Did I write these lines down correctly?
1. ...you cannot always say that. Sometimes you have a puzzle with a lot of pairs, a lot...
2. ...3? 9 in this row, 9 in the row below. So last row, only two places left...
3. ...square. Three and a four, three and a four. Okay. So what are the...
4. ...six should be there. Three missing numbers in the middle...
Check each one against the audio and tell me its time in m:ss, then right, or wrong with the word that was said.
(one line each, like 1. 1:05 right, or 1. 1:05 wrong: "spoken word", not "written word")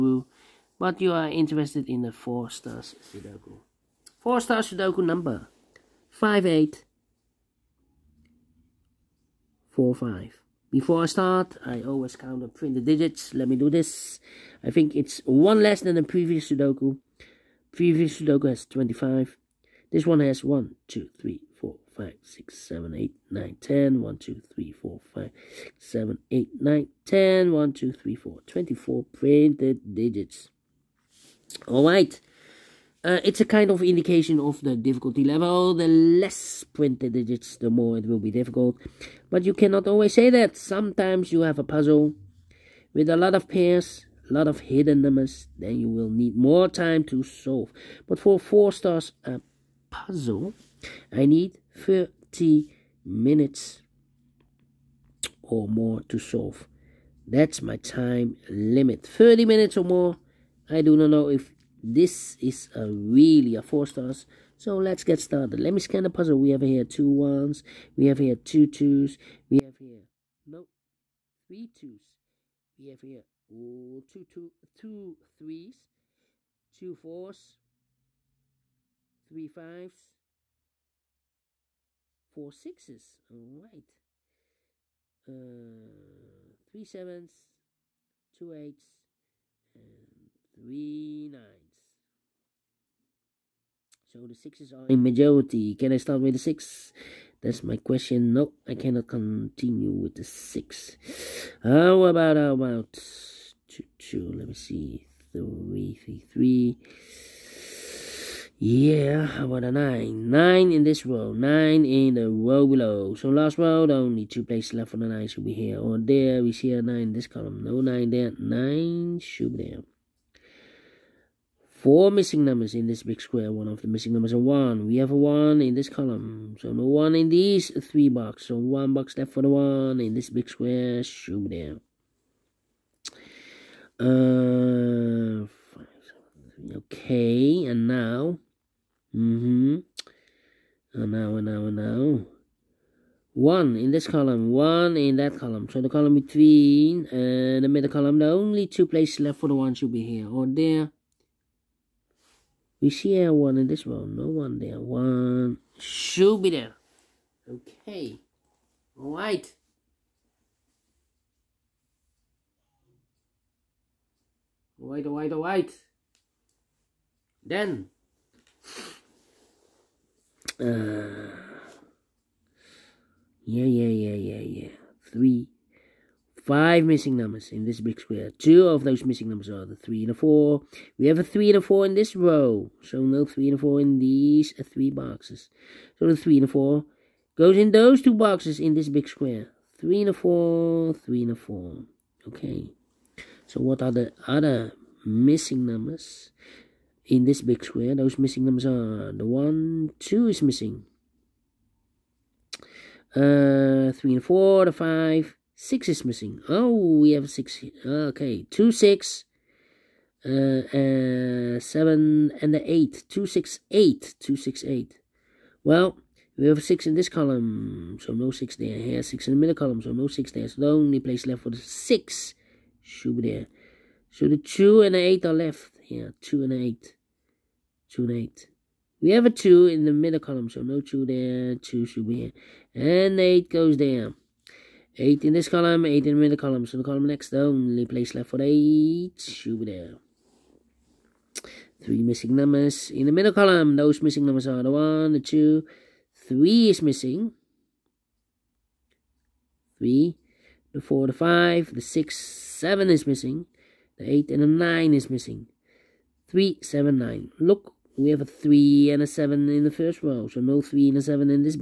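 1. 0:39 right
2. 1:49 wrong: "9", not "3"
3. 3:09 right
4. 3:58 wrong: "eight", not "six".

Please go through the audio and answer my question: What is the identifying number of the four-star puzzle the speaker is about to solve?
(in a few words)
5845.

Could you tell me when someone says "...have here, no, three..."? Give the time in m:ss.
1:09.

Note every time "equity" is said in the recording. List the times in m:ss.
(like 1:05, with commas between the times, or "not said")
not said.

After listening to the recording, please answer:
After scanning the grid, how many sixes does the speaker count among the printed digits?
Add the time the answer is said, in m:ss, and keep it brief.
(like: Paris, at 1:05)
4, at 1:22.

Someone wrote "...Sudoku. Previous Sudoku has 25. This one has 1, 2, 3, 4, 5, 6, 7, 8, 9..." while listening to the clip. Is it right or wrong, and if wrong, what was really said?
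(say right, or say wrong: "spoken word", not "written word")
right.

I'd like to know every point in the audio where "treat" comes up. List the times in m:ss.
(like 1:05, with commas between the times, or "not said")
not said.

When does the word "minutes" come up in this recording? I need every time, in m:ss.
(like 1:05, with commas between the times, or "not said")
0:53, 0:59.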